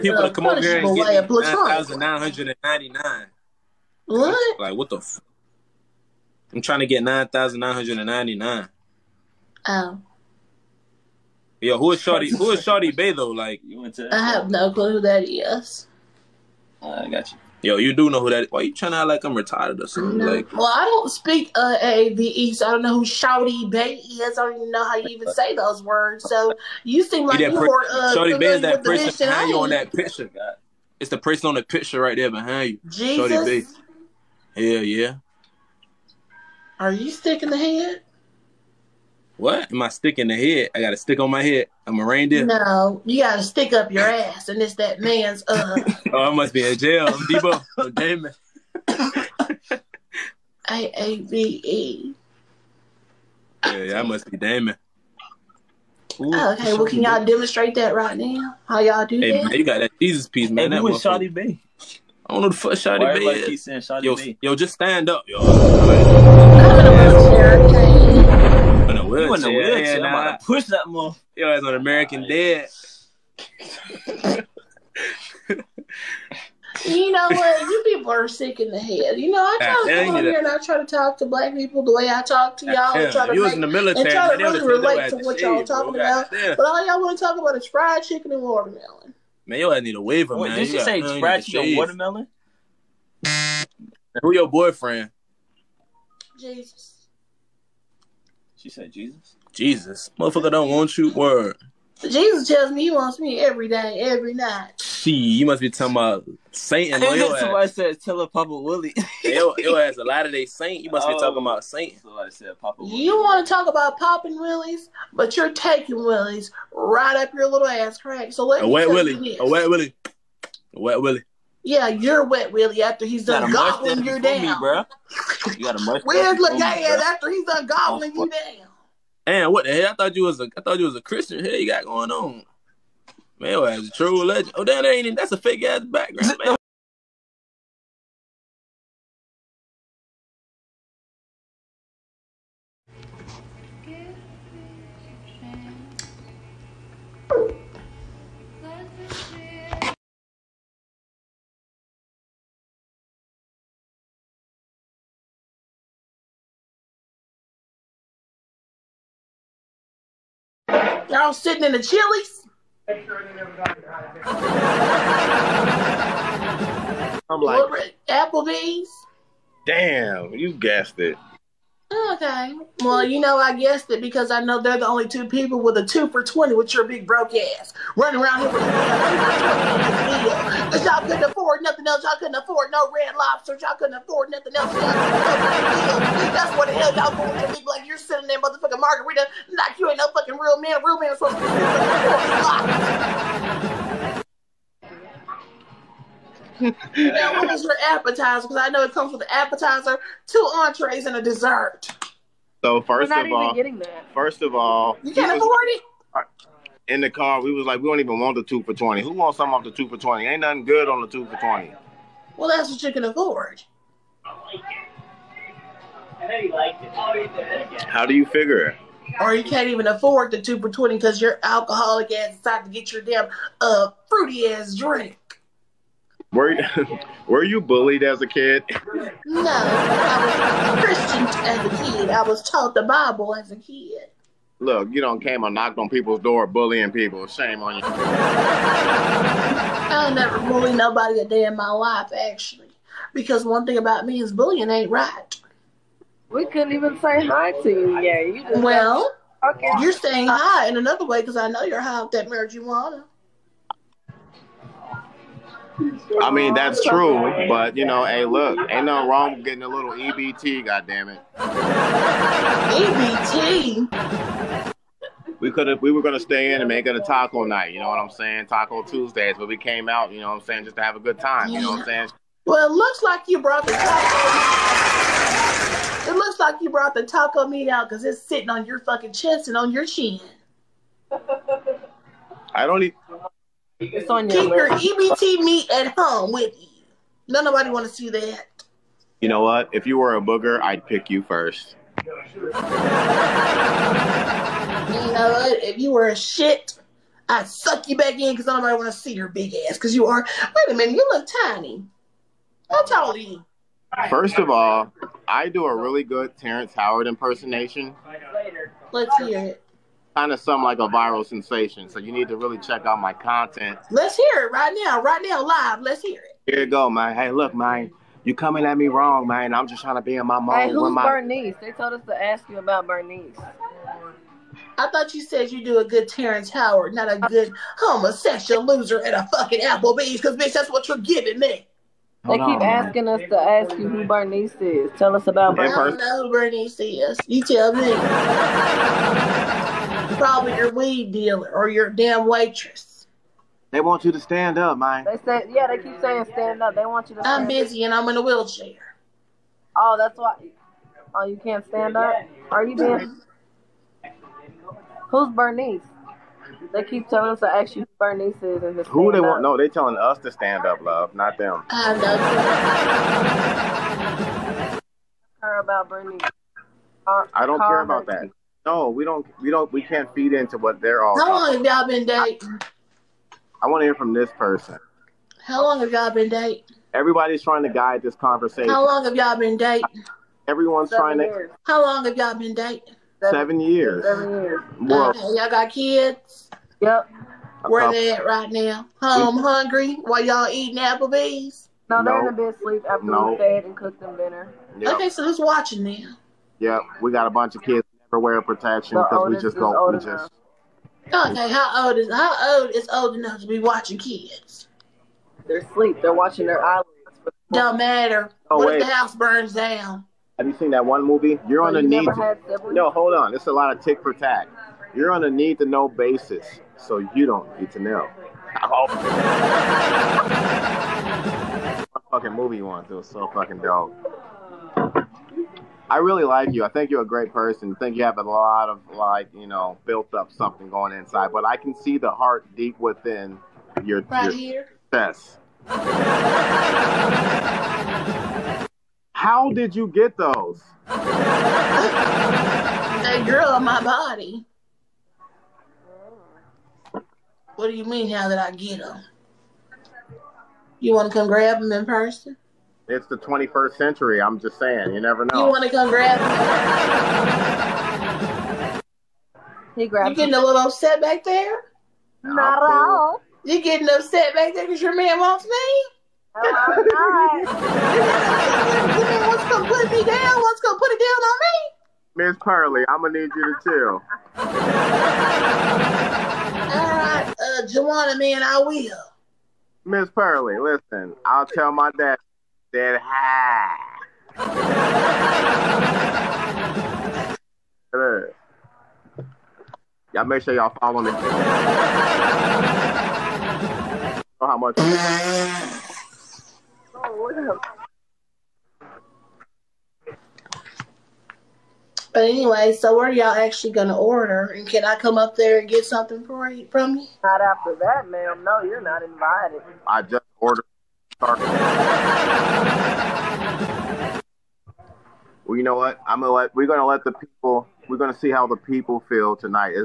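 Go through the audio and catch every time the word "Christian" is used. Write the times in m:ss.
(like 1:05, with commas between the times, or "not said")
2:11, 3:50.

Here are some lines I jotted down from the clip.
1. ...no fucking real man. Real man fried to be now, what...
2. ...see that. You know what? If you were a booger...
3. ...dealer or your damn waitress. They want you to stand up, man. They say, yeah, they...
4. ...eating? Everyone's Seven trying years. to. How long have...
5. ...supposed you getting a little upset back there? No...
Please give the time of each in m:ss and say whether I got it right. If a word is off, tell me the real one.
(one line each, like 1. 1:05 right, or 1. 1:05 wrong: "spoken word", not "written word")
1. 3:09 wrong: "supposed", not "fried"
2. 4:47 right
3. 5:41 right
4. 6:19 wrong: "dating", not "eating"
5. 7:39 wrong: "grabbed", not "supposed".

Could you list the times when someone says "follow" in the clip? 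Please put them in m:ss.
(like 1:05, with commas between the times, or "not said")
8:10.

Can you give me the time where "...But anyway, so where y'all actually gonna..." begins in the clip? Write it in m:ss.
8:22.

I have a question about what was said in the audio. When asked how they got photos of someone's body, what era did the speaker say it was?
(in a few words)
21st century.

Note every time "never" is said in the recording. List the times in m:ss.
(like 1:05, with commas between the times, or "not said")
4:00, 6:38, 7:35.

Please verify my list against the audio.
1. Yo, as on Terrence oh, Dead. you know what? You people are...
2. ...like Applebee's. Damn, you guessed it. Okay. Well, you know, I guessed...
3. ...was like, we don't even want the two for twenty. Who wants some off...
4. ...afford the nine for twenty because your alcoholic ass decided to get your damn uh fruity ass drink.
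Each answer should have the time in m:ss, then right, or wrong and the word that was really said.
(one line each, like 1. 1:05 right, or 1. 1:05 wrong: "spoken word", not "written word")
1. 1:11 wrong: "American", not "Terrence"
2. 2:47 right
3. 3:27 right
4. 3:39 wrong: "two", not "nine".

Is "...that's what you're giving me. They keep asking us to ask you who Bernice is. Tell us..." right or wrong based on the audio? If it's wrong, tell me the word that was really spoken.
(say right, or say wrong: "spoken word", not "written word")
right.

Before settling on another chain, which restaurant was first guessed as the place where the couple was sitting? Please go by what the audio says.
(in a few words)
Chili's.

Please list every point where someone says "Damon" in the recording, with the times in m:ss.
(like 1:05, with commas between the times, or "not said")
0:47, 0:54.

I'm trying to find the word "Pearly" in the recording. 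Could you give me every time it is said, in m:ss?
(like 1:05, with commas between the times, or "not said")
7:52, 8:00.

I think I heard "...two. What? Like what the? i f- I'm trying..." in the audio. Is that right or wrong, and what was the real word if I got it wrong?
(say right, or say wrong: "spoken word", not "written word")
wrong: "nine", not "two".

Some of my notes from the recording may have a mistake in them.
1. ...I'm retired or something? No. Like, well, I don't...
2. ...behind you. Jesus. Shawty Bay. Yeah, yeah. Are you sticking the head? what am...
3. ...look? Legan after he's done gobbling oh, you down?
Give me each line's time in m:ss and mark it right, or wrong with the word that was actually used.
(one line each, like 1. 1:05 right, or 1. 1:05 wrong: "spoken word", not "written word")
1. 0:19 right
2. 0:32 right
3. 2:06 right.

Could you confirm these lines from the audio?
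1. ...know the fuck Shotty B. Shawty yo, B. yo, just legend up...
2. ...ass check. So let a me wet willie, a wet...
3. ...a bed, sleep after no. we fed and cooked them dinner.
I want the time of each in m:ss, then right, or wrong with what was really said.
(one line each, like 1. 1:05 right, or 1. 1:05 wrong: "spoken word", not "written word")
1. 1:02 wrong: "stand", not "legend"
2. 1:57 wrong: "crack", not "check"
3. 6:32 right.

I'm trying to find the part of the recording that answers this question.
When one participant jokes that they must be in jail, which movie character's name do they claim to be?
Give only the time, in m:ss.
0:47.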